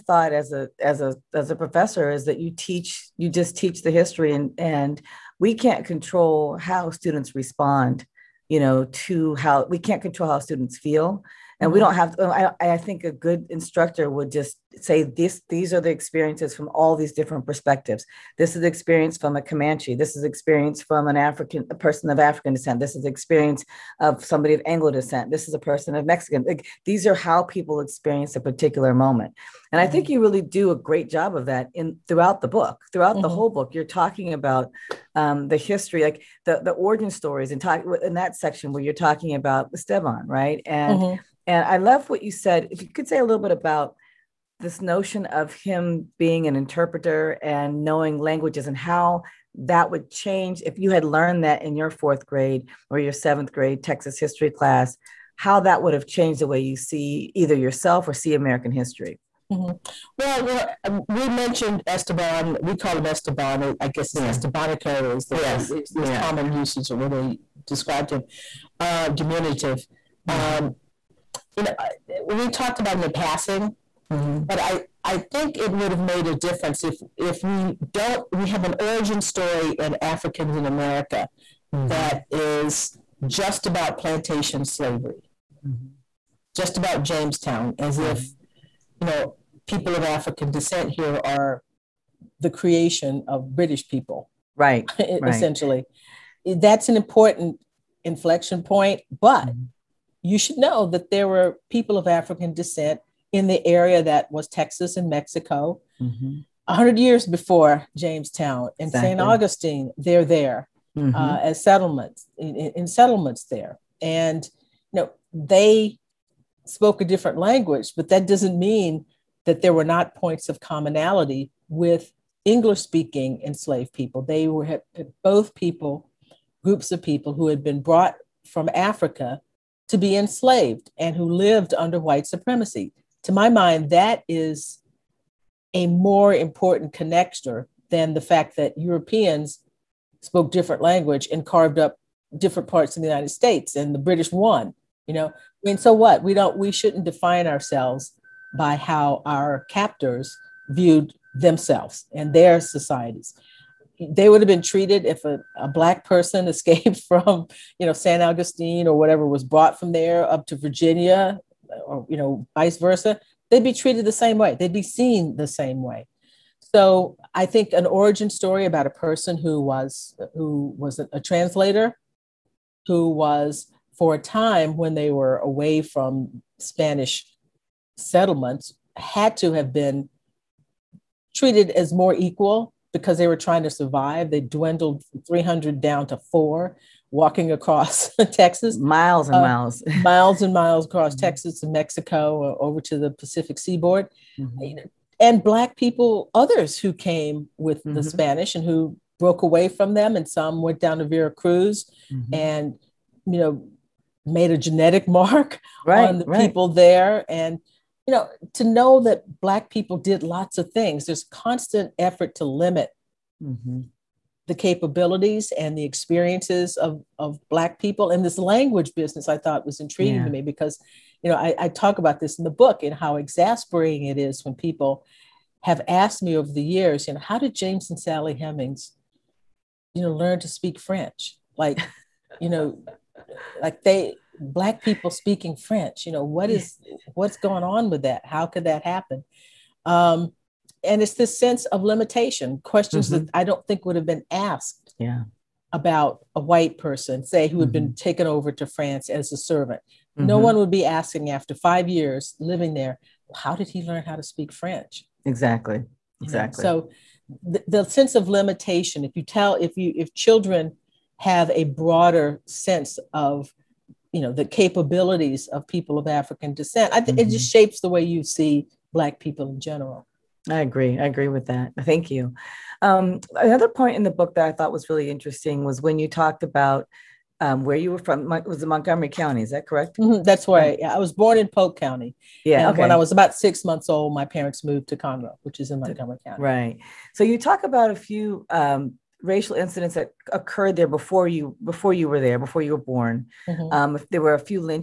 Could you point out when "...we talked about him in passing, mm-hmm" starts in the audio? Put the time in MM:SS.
01:12.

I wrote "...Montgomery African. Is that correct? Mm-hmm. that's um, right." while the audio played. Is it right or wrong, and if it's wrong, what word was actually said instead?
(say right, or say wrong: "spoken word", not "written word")
wrong: "County", not "African".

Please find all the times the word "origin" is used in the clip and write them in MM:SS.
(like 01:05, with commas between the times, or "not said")
00:36, 01:18, 02:47.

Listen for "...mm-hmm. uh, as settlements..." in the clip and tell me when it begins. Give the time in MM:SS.
01:50.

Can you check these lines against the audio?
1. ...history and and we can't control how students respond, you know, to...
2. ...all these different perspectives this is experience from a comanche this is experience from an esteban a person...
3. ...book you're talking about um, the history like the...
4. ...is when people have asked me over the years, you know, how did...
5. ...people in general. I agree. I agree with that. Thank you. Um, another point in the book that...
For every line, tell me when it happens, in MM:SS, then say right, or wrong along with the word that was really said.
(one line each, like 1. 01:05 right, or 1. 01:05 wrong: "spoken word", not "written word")
1. 00:03 right
2. 00:16 wrong: "african", not "esteban"
3. 00:33 right
4. 03:44 right
5. 04:29 right.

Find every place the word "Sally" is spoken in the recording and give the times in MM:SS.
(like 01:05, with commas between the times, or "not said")
03:47.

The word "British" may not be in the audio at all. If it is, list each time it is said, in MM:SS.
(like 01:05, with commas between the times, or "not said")
01:33, 02:23.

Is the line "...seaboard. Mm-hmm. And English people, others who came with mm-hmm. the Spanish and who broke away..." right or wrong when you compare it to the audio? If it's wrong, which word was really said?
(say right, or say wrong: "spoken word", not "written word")
wrong: "Black", not "English".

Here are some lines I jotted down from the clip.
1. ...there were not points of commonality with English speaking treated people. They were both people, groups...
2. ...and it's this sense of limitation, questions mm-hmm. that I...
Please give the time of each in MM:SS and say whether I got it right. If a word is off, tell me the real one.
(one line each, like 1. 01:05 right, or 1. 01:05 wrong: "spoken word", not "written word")
1. 01:59 wrong: "enslaved", not "treated"
2. 04:00 right.